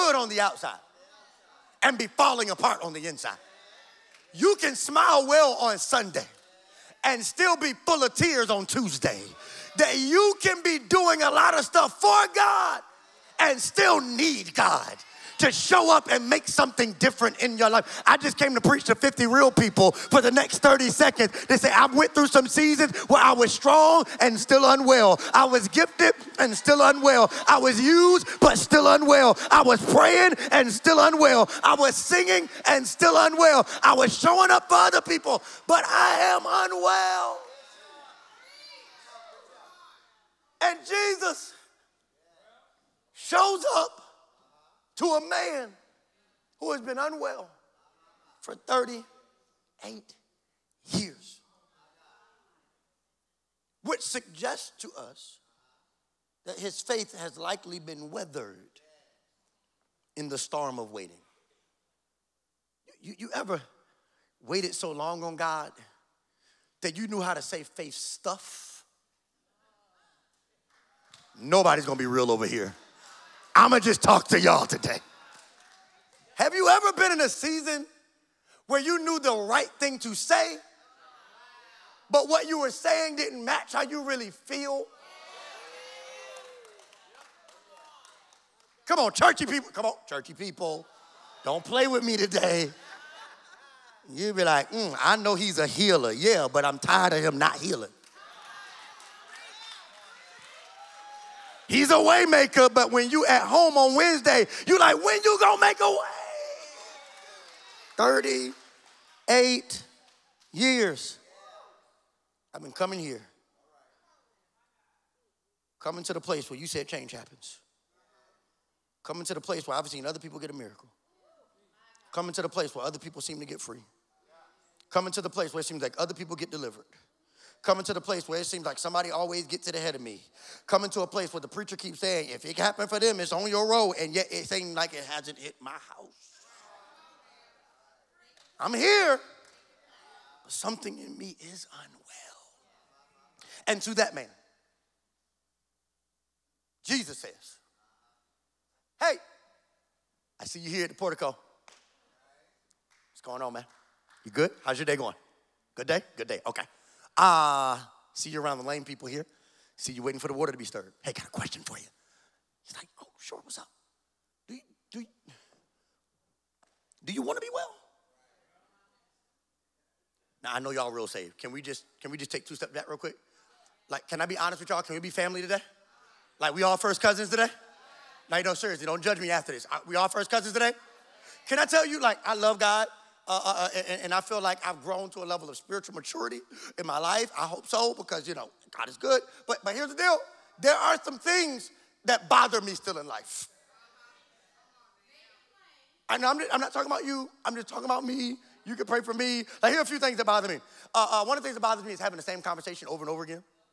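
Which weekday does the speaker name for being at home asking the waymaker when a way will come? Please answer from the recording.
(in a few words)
Wednesday.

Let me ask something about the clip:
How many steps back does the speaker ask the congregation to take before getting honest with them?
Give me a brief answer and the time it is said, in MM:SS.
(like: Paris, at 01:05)
2, at 02:52.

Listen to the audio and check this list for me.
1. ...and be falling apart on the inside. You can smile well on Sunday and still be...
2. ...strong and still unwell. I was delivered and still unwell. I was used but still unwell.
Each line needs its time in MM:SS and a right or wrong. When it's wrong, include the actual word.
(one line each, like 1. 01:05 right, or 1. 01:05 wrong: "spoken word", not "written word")
1. 00:01 right
2. 00:23 wrong: "gifted", not "delivered".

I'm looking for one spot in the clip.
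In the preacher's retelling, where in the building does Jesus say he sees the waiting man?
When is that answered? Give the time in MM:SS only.
02:30.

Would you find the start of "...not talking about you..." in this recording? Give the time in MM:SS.
03:16.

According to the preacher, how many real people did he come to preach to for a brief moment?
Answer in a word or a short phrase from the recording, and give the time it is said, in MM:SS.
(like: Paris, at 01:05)
50, at 00:18.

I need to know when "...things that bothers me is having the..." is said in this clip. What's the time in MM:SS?
03:21.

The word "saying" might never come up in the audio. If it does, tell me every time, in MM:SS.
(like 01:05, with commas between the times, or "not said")
01:22, 02:11.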